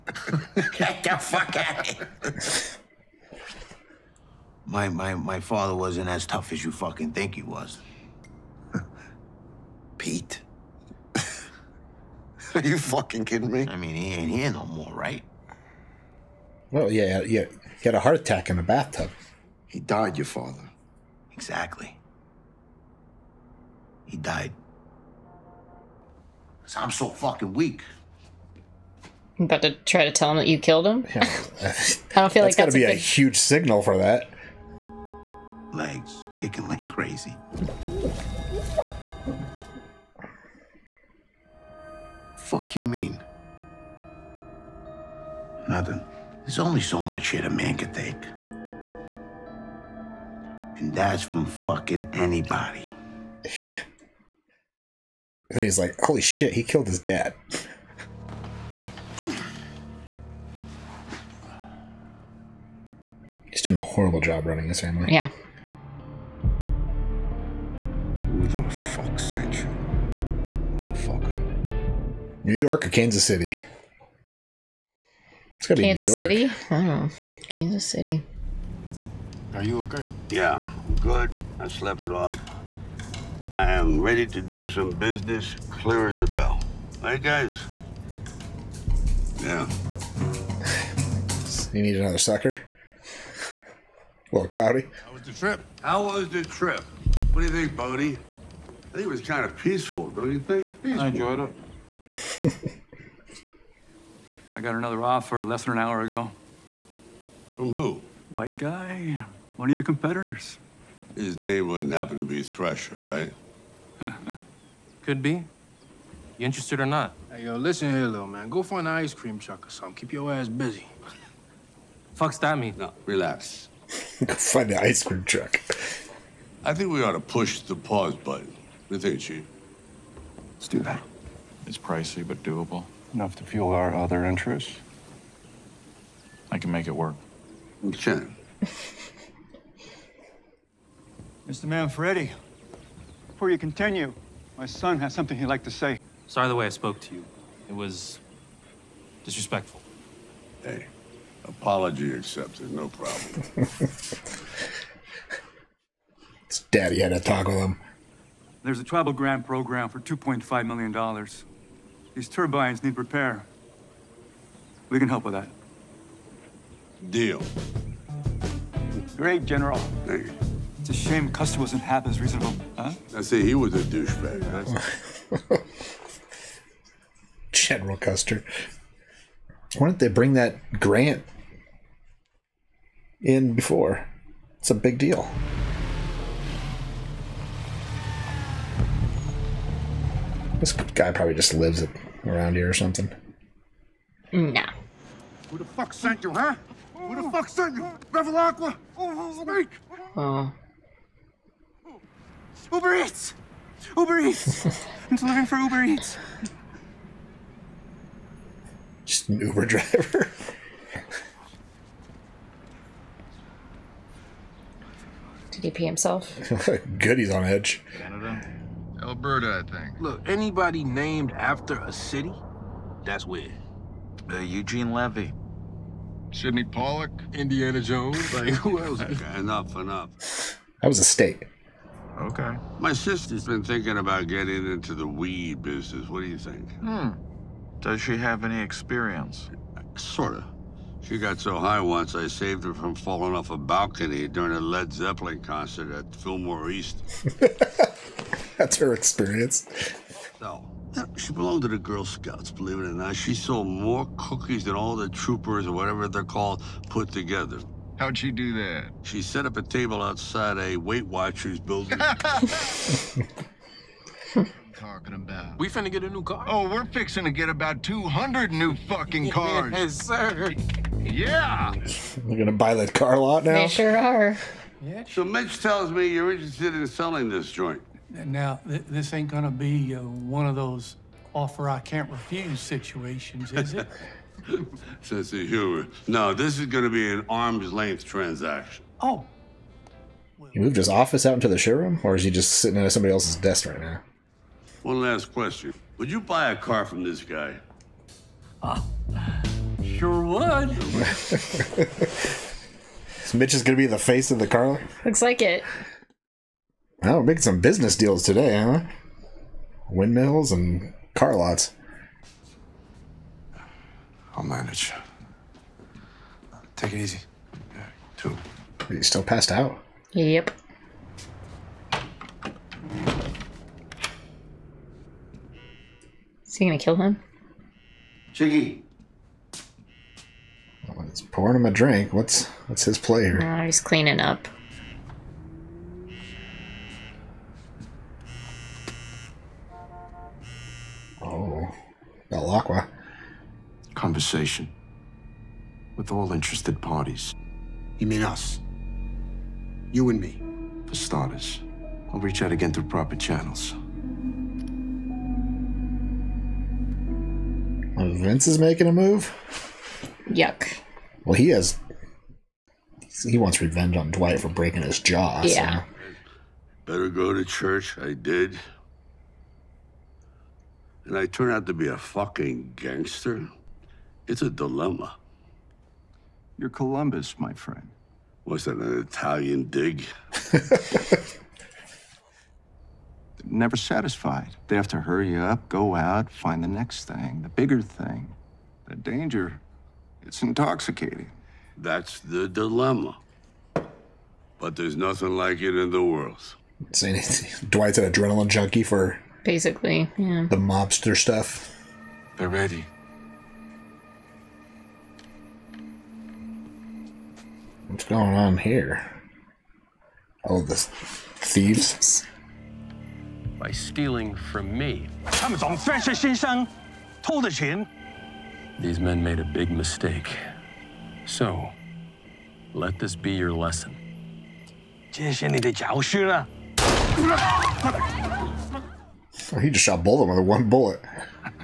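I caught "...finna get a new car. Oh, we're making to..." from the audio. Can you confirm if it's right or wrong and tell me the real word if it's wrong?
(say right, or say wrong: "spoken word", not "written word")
wrong: "fixing", not "making".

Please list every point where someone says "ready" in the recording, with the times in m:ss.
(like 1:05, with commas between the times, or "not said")
1:24, 6:42.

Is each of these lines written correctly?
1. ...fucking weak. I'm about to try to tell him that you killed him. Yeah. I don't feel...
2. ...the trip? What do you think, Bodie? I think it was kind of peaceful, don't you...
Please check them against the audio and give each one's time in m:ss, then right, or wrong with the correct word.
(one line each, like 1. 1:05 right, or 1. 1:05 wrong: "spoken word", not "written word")
1. 0:27 right
2. 1:36 right.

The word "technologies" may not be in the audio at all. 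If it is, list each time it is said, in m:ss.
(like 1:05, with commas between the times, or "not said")
not said.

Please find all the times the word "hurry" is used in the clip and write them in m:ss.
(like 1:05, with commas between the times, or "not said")
6:25.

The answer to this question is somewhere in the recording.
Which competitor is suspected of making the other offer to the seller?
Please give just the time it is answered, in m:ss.
1:52.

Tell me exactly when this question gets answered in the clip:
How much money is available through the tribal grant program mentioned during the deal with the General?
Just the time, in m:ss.
2:40.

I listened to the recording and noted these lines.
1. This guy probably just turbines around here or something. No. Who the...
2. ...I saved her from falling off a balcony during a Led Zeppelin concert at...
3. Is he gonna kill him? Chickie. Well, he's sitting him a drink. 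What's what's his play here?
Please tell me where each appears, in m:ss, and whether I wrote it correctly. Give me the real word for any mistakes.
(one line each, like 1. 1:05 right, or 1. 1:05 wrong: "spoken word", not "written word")
1. 3:10 wrong: "lives", not "turbines"
2. 4:02 right
3. 5:26 wrong: "pouring", not "sitting".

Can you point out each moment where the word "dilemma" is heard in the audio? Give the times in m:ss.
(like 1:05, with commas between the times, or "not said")
6:14, 6:32.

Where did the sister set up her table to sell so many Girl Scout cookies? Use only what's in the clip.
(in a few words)
Outside a Weight Watchers building.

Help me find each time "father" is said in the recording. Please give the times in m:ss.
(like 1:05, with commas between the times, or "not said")
0:05, 0:20.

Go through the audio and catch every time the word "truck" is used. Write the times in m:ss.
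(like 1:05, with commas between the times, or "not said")
1:59, 2:05.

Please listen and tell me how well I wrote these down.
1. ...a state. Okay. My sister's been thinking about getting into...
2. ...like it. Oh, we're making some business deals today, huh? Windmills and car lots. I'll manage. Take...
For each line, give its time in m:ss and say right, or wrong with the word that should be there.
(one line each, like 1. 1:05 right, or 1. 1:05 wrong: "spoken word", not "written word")
1. 3:50 right
2. 5:05 right.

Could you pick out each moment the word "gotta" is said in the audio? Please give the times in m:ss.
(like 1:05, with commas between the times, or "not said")
1:15.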